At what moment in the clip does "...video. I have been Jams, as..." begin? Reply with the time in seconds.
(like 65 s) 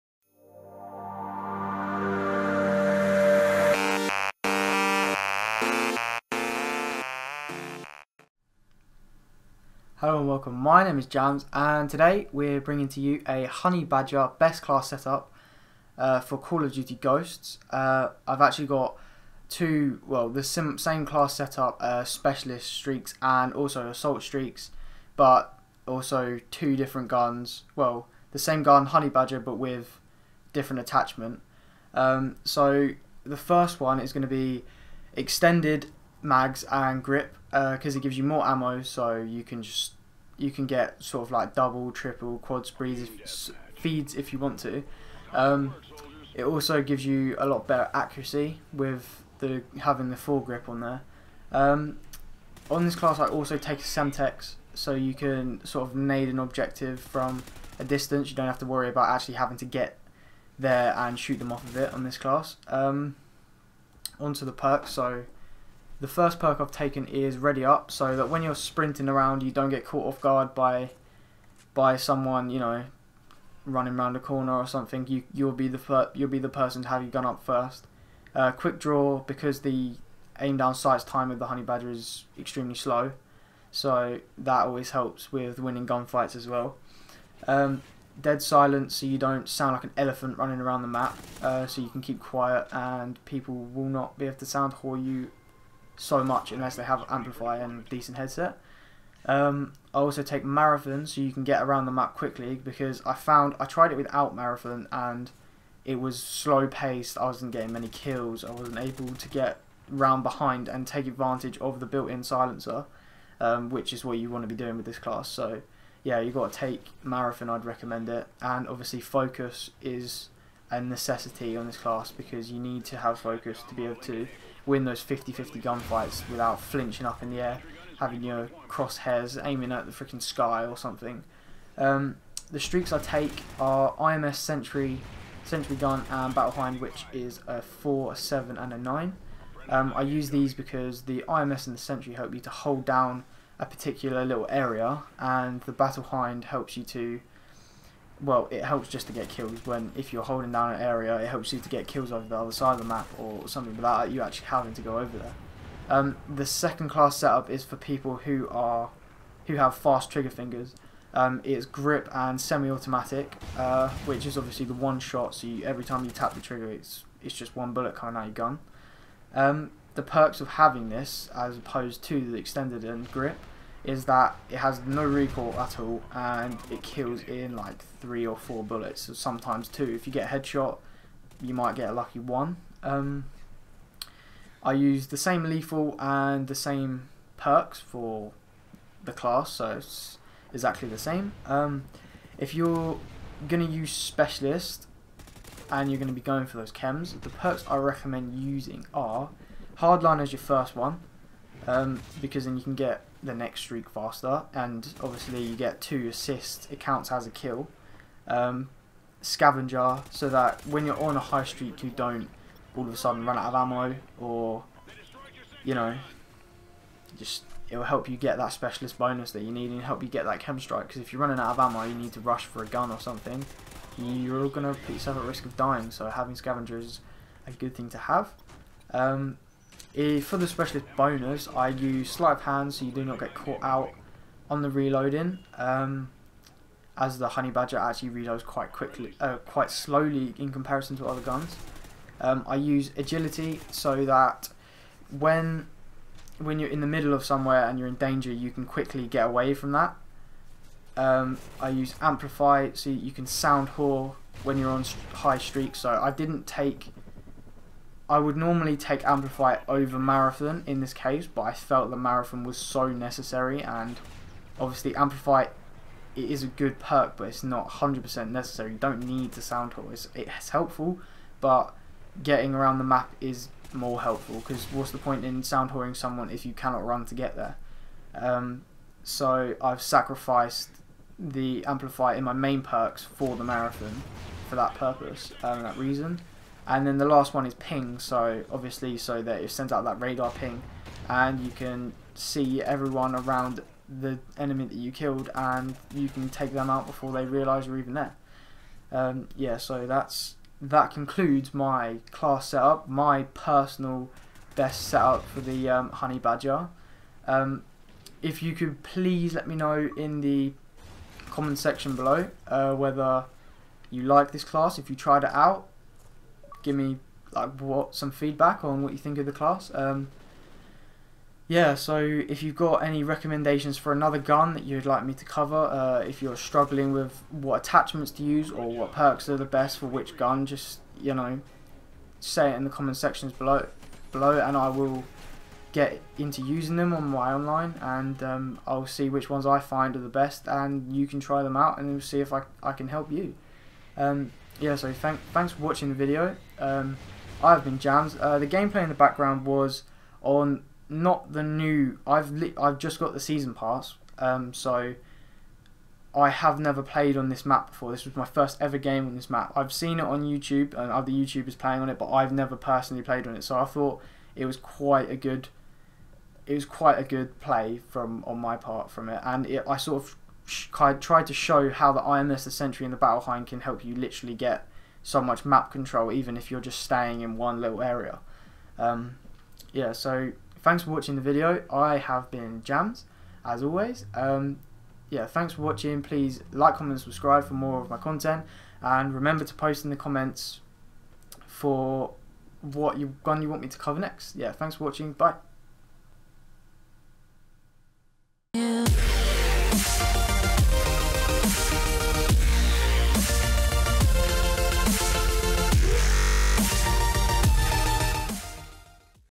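381 s.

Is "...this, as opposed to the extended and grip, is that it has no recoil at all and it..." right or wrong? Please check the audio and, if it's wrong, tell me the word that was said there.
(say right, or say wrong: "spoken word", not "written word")
right.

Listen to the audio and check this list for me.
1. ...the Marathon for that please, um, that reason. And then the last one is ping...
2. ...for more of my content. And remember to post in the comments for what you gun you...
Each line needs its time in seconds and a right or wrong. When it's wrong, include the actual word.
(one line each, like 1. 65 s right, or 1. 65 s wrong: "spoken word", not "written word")
1. 283 s wrong: "purpose", not "please"
2. 387 s right.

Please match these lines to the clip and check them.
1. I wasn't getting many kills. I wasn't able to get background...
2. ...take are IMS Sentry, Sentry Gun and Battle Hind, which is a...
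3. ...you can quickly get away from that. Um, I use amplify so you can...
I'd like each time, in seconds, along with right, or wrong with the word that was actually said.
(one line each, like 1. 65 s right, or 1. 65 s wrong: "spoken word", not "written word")
1. 107 s wrong: "round", not "background"
2. 132 s right
3. 248 s right.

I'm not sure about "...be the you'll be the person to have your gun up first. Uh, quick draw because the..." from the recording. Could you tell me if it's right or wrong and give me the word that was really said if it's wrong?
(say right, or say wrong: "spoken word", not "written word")
right.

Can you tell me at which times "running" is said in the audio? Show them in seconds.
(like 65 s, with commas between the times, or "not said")
73 s, 90 s, 221 s.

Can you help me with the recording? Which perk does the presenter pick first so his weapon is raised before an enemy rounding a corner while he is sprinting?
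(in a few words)
Ready Up.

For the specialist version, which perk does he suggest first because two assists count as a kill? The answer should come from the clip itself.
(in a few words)
Hardline.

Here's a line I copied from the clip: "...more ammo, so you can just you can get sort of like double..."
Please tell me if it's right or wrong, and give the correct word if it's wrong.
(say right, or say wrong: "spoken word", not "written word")
right.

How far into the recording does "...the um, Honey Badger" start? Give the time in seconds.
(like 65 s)
305 s.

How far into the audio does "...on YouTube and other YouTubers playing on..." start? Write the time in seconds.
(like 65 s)
360 s.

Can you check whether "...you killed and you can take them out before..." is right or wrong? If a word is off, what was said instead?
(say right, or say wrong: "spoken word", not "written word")
right.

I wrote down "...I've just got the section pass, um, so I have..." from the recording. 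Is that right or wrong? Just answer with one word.
wrong.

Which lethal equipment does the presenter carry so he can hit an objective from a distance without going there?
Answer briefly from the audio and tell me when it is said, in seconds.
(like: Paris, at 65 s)
Semtex, at 53 s.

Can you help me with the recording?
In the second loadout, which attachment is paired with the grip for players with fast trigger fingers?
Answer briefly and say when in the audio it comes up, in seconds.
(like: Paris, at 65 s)
semi-automatic, at 162 s.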